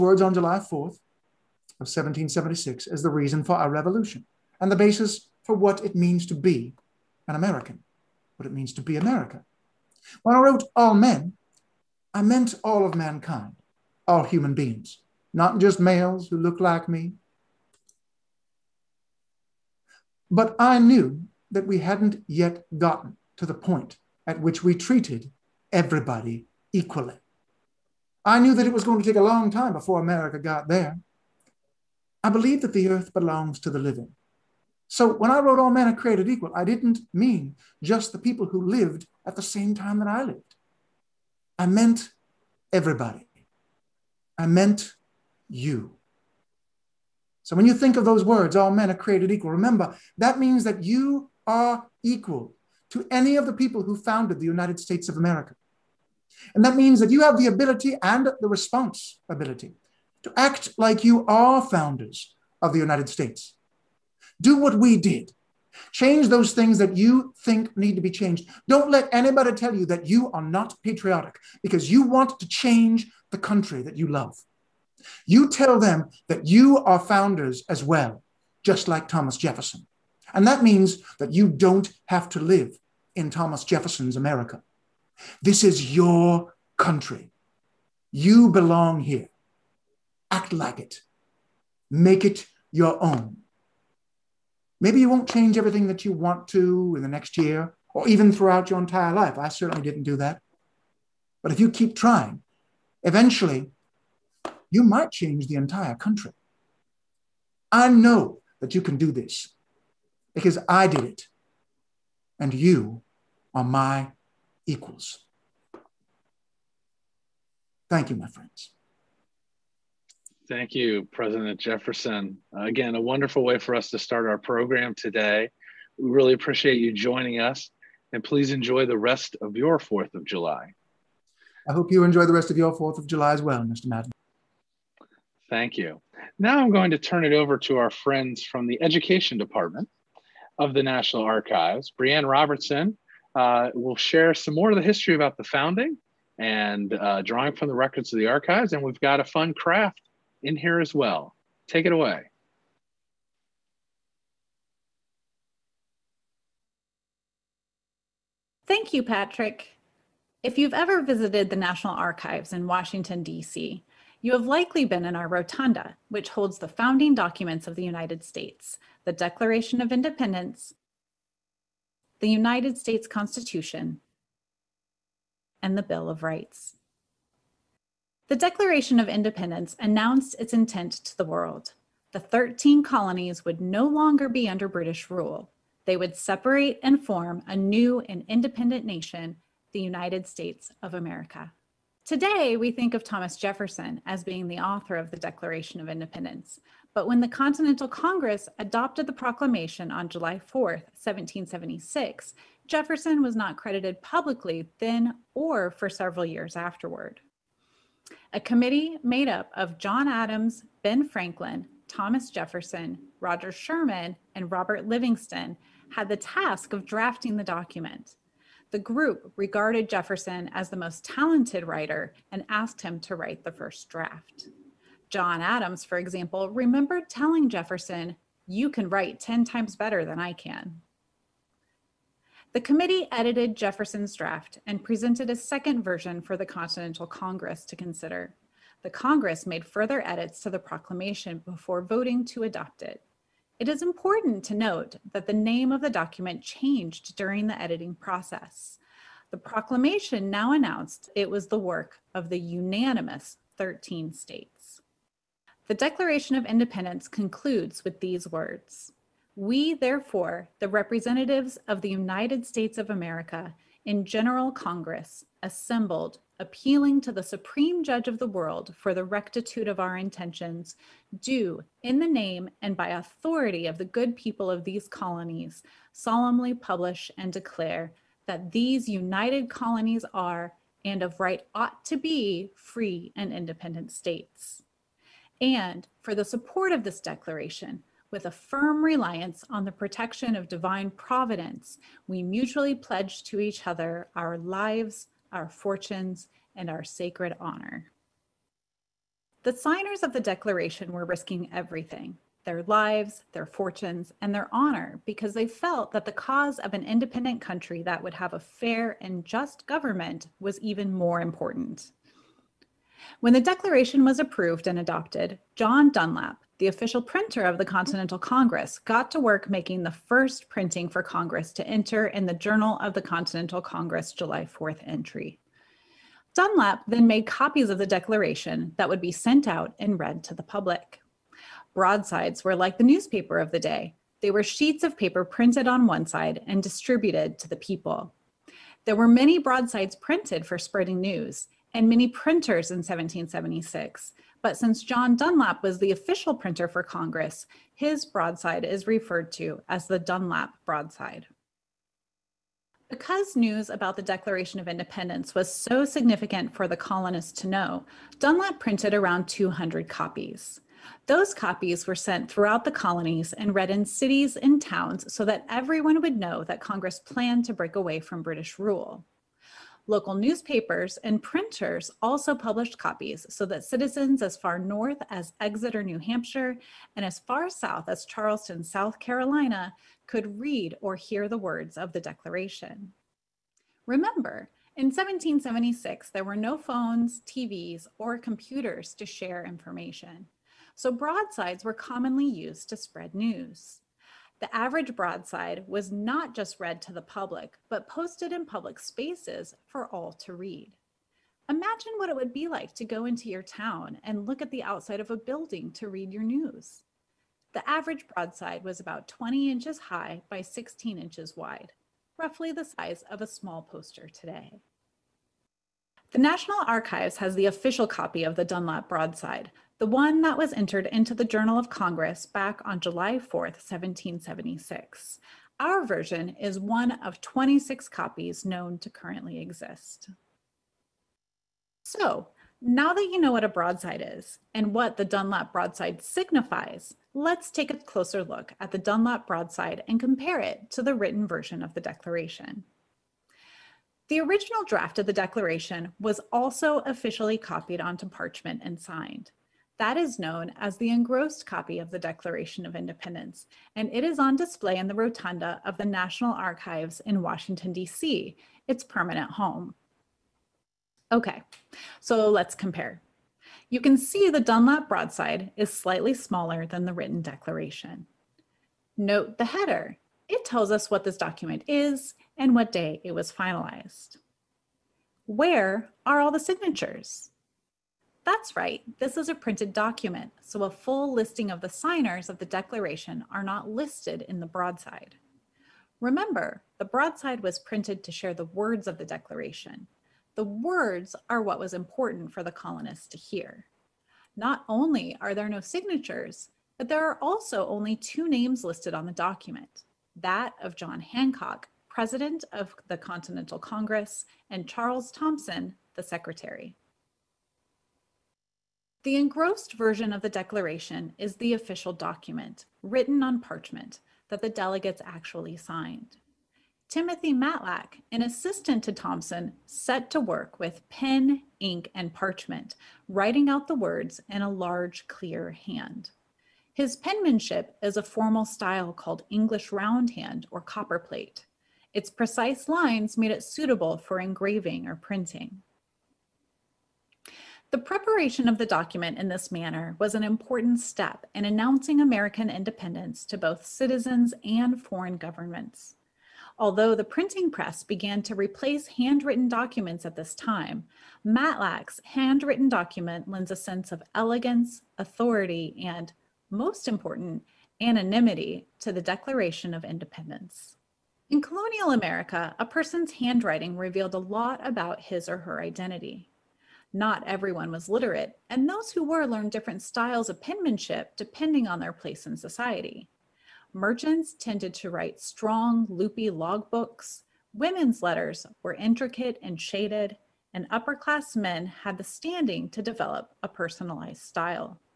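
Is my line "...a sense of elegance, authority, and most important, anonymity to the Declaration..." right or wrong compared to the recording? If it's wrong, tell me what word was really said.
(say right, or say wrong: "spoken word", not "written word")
right.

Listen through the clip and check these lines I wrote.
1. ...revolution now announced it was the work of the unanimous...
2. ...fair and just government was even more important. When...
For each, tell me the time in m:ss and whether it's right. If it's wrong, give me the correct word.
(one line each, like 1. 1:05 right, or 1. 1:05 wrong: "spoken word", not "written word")
1. 4:09 wrong: "proclamation", not "revolution"
2. 5:08 right.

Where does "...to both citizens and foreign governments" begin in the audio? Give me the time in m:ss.
9:03.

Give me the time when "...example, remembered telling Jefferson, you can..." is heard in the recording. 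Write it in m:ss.
3:45.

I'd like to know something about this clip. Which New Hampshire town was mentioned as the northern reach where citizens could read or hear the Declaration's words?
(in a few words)
Exeter.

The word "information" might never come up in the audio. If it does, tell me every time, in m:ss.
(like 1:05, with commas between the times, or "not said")
6:29.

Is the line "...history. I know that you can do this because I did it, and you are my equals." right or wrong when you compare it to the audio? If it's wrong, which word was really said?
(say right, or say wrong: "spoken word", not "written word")
wrong: "country", not "history".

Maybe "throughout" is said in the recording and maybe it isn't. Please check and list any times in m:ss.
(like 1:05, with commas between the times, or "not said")
1:38, 6:02.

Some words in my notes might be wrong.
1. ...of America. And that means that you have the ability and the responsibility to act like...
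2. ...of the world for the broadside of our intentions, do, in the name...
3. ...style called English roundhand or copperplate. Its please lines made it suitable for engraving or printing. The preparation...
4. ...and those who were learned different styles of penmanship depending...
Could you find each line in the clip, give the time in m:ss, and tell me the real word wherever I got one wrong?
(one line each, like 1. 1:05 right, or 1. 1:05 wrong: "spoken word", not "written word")
1. 0:55 right
2. 4:28 wrong: "rectitude", not "broadside"
3. 8:48 wrong: "precise", not "please"
4. 9:28 right.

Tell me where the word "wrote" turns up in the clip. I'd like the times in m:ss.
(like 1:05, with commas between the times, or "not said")
0:10, 0:35.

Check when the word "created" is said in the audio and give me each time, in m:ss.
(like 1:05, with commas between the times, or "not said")
0:35, 0:48.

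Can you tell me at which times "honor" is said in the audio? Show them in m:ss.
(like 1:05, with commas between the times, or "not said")
4:57, 5:04.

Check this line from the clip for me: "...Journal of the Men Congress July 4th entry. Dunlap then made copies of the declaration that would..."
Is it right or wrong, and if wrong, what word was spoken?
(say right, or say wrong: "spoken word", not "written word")
wrong: "Continental", not "Men".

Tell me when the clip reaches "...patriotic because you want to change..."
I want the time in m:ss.
1:10.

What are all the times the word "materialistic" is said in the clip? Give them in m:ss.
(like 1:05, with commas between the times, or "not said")
not said.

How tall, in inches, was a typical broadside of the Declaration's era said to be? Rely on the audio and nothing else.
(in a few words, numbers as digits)
20 inches.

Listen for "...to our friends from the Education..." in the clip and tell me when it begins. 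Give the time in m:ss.
2:17.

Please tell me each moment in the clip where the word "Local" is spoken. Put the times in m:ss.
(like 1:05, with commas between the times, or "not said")
6:09.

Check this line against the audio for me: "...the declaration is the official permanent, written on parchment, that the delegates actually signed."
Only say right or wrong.
wrong.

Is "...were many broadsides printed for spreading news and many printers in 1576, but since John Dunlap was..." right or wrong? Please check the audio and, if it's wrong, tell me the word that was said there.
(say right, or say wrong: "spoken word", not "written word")
wrong: "1776", not "1576".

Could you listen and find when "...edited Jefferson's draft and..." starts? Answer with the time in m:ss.
3:53.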